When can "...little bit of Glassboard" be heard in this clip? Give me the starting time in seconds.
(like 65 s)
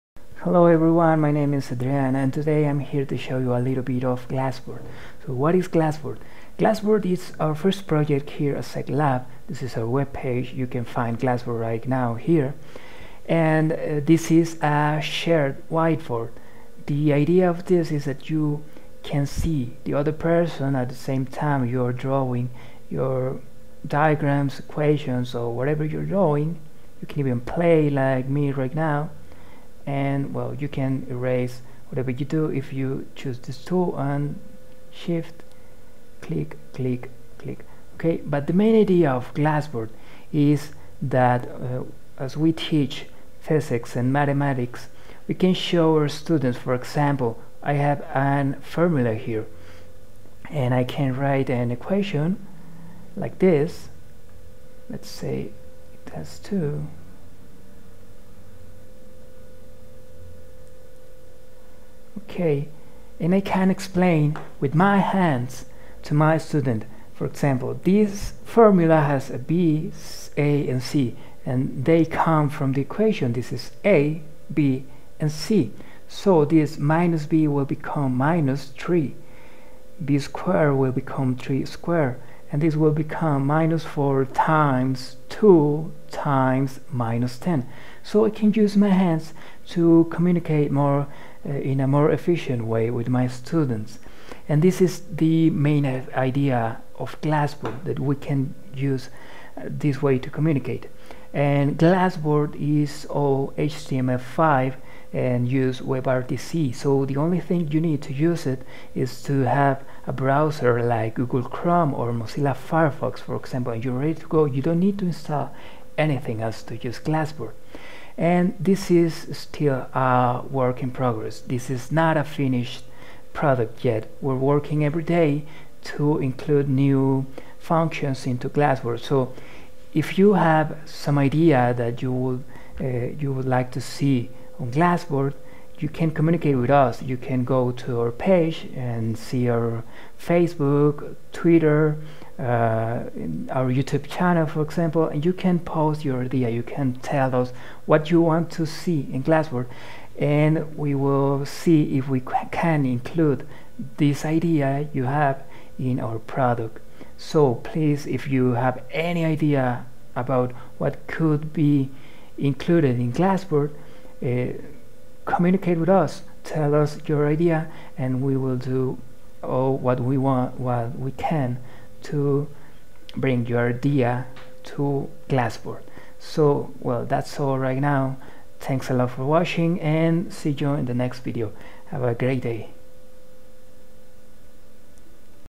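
3 s.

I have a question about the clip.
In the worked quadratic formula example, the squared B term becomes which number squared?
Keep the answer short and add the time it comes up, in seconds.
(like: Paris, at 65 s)
3, at 81 s.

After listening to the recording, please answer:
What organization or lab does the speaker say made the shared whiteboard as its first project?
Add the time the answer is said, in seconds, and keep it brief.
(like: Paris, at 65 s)
Zehc-Lab, at 8 s.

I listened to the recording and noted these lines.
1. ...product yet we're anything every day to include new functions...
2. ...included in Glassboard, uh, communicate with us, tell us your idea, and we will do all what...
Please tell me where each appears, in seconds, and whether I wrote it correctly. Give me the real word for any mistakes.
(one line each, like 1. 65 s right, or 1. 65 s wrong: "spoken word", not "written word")
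1. 123 s wrong: "working", not "anything"
2. 162 s right.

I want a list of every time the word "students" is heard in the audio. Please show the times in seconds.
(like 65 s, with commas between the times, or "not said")
46 s, 66 s, 93 s.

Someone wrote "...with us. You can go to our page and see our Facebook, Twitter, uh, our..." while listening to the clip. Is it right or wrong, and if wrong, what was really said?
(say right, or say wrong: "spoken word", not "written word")
right.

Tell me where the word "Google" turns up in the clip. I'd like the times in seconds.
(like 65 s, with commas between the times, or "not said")
111 s.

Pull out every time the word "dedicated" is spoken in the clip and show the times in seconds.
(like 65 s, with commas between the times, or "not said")
not said.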